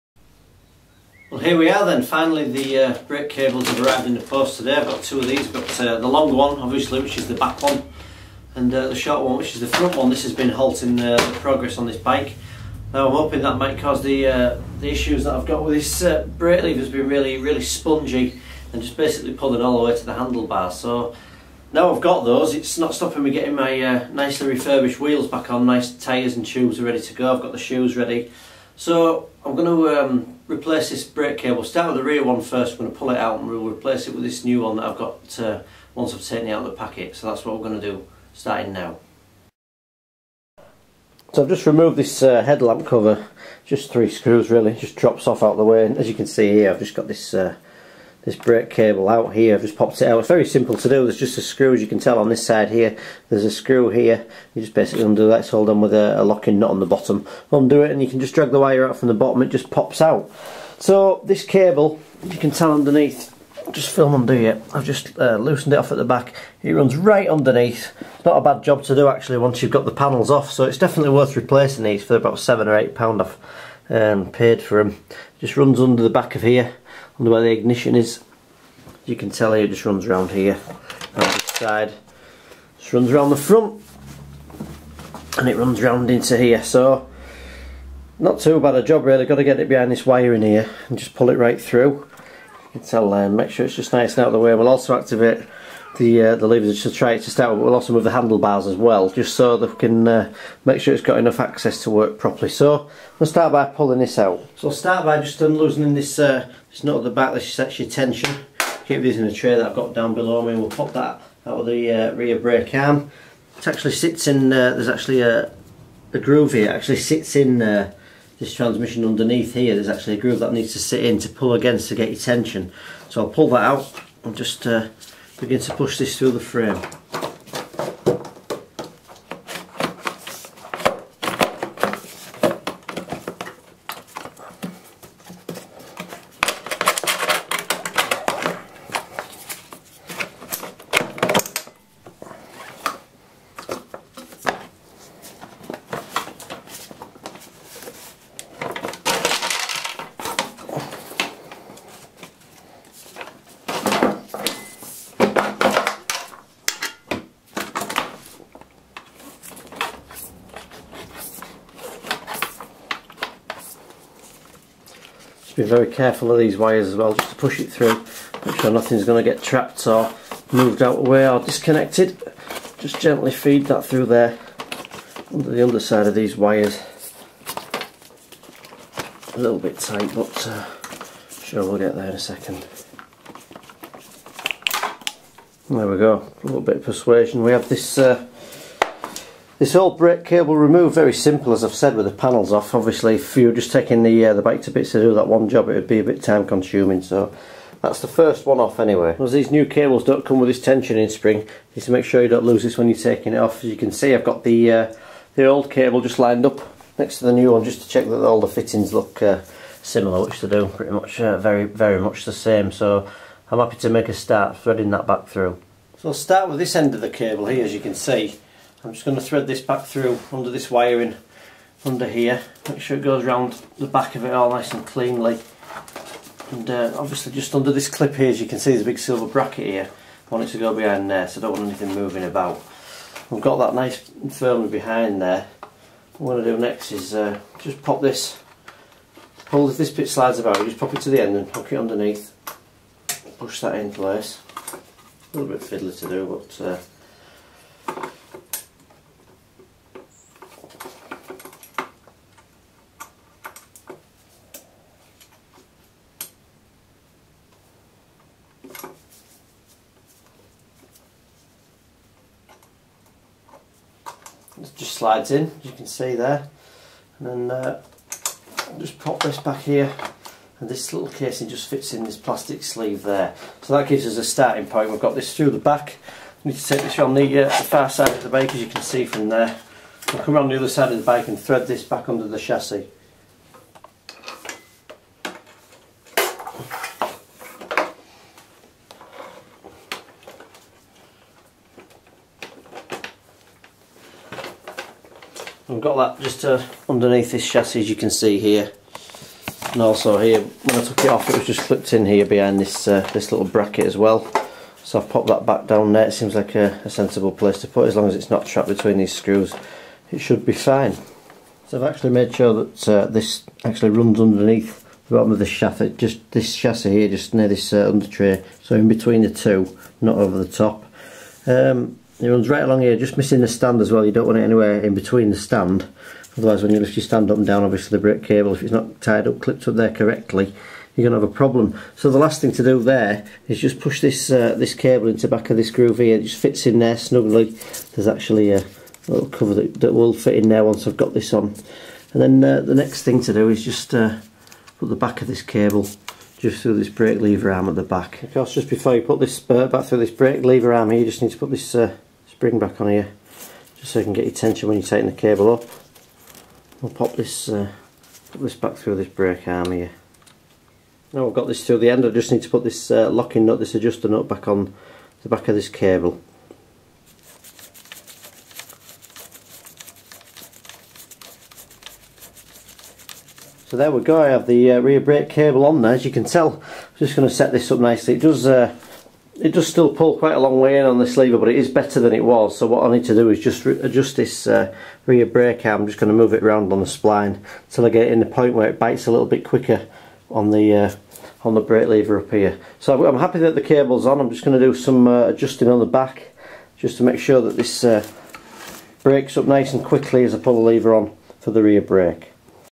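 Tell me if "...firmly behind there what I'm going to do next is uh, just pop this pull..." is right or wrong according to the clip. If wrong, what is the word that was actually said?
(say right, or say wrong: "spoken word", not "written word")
right.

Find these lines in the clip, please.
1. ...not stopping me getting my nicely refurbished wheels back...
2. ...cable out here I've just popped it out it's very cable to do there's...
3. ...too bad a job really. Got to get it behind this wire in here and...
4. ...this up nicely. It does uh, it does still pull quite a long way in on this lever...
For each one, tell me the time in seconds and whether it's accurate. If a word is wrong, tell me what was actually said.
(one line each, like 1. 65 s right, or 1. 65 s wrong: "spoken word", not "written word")
1. 22 s right
2. 48 s wrong: "simple", not "cable"
3. 88 s right
4. 377 s right.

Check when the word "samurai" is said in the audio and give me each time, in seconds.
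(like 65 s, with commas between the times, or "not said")
not said.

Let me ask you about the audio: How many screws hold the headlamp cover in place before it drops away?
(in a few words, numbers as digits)
3.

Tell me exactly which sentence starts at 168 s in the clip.
Make sure nothing's going to get trapped or moved out of the way or disconnected.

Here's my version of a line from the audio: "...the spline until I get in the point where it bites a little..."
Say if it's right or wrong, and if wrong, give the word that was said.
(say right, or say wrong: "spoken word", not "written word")
right.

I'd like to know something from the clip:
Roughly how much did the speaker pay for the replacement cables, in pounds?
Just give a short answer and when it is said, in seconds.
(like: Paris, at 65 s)
7 or 8 pounds, at 72 s.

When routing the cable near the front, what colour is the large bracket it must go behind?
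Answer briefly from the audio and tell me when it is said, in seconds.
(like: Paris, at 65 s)
silver, at 228 s.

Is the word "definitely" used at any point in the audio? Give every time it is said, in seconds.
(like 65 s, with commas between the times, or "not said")
70 s.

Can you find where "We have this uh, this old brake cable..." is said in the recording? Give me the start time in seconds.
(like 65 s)
187 s.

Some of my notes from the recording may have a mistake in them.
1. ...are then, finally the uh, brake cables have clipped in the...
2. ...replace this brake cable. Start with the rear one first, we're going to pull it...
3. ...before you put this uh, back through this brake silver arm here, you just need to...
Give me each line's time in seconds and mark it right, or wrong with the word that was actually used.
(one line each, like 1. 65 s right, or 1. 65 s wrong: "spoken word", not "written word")
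1. 1 s wrong: "arrived", not "clipped"
2. 30 s right
3. 348 s wrong: "lever", not "silver".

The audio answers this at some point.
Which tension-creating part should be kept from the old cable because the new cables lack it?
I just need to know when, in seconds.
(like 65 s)
200 s.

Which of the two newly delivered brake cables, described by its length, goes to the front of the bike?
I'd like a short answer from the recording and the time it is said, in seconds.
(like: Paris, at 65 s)
the short one, at 8 s.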